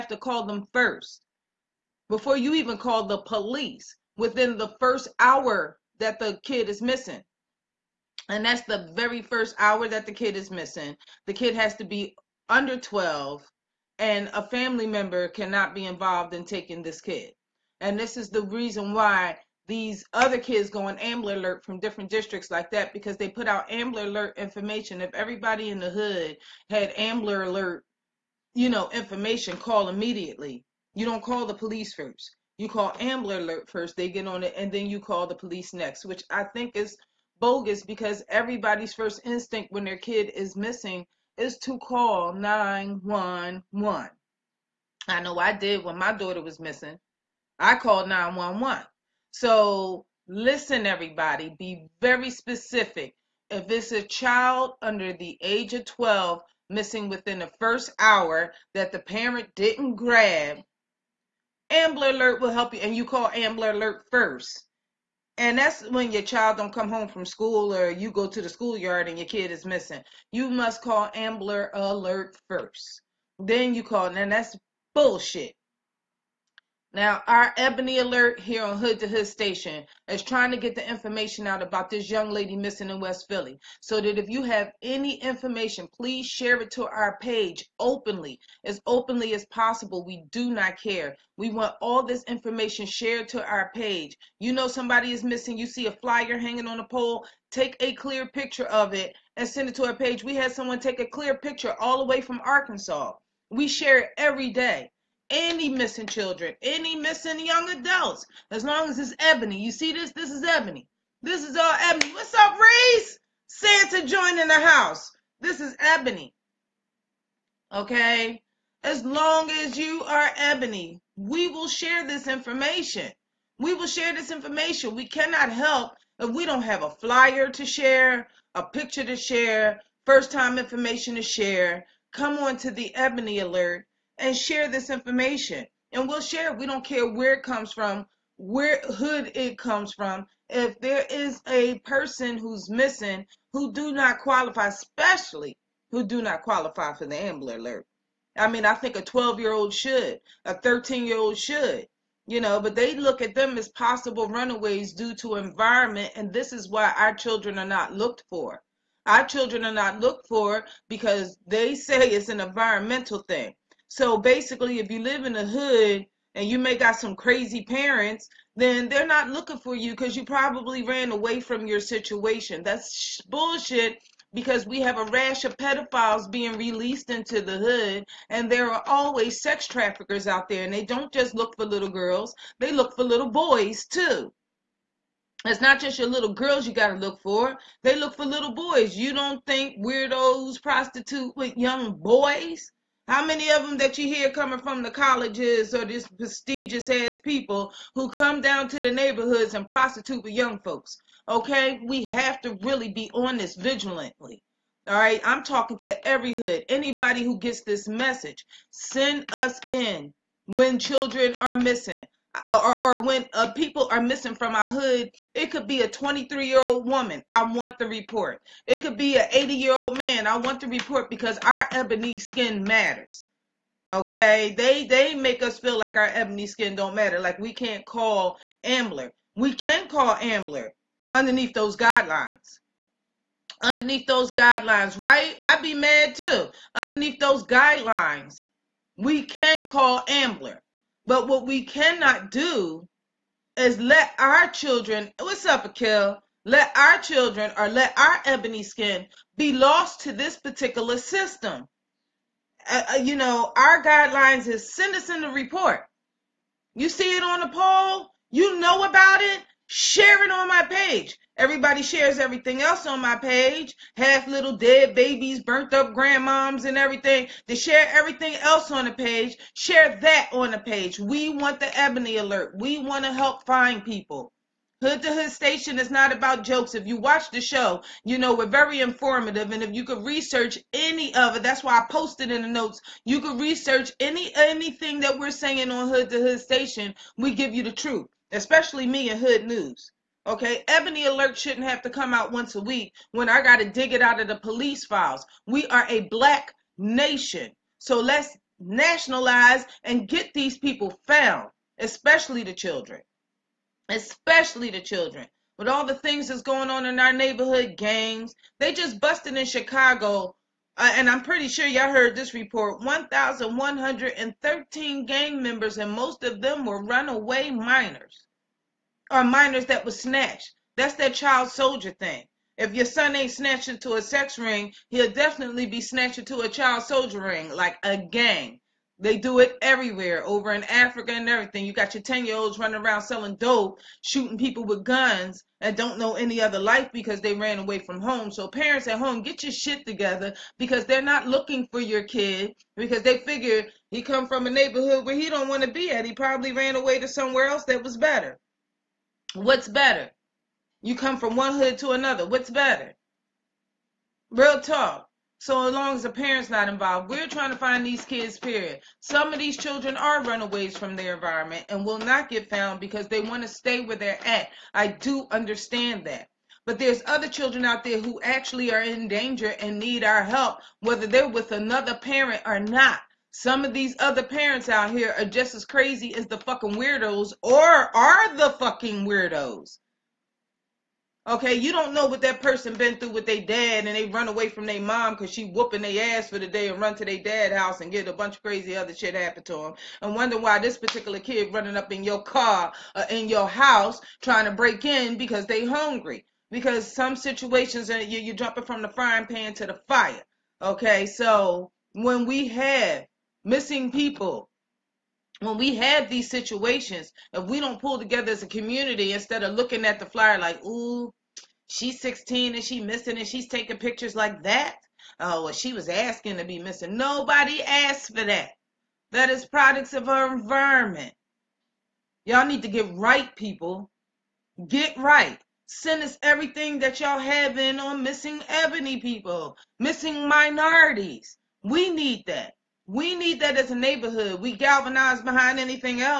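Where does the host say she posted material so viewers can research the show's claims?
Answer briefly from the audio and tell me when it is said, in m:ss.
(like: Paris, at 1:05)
In the notes, at 4:42.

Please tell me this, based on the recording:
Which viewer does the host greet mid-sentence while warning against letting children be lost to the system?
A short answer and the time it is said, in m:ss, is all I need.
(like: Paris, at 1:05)
Akil, at 4:05.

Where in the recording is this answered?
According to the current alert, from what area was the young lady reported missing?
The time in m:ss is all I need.
1:22.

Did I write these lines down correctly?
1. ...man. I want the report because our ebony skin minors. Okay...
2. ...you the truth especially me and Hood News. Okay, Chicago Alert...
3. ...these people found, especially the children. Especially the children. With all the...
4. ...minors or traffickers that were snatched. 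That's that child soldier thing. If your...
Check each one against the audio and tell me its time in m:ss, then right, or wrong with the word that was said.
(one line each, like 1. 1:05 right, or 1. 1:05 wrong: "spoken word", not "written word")
1. 3:39 wrong: "matters", not "minors"
2. 4:47 wrong: "Ebony", not "Chicago"
3. 5:00 right
4. 5:17 wrong: "minors", not "traffickers".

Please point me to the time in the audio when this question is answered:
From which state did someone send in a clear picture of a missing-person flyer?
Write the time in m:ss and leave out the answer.
1:42.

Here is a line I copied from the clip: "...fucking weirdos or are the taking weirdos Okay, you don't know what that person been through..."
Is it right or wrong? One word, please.
wrong.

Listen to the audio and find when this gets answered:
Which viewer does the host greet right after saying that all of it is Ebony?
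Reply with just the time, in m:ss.
1:52.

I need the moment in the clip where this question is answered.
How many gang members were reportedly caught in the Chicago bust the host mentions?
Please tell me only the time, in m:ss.
5:12.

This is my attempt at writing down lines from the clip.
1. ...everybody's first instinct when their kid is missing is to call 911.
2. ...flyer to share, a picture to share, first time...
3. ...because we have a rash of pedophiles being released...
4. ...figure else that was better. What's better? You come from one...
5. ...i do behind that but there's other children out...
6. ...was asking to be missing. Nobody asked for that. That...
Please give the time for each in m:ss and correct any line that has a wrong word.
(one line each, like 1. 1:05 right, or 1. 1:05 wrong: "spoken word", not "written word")
1. 0:38 right
2. 2:06 right
3. 2:54 right
4. 5:47 wrong: "somewhere", not "figure"
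5. 6:04 wrong: "understand", not "behind"
6. 6:55 right.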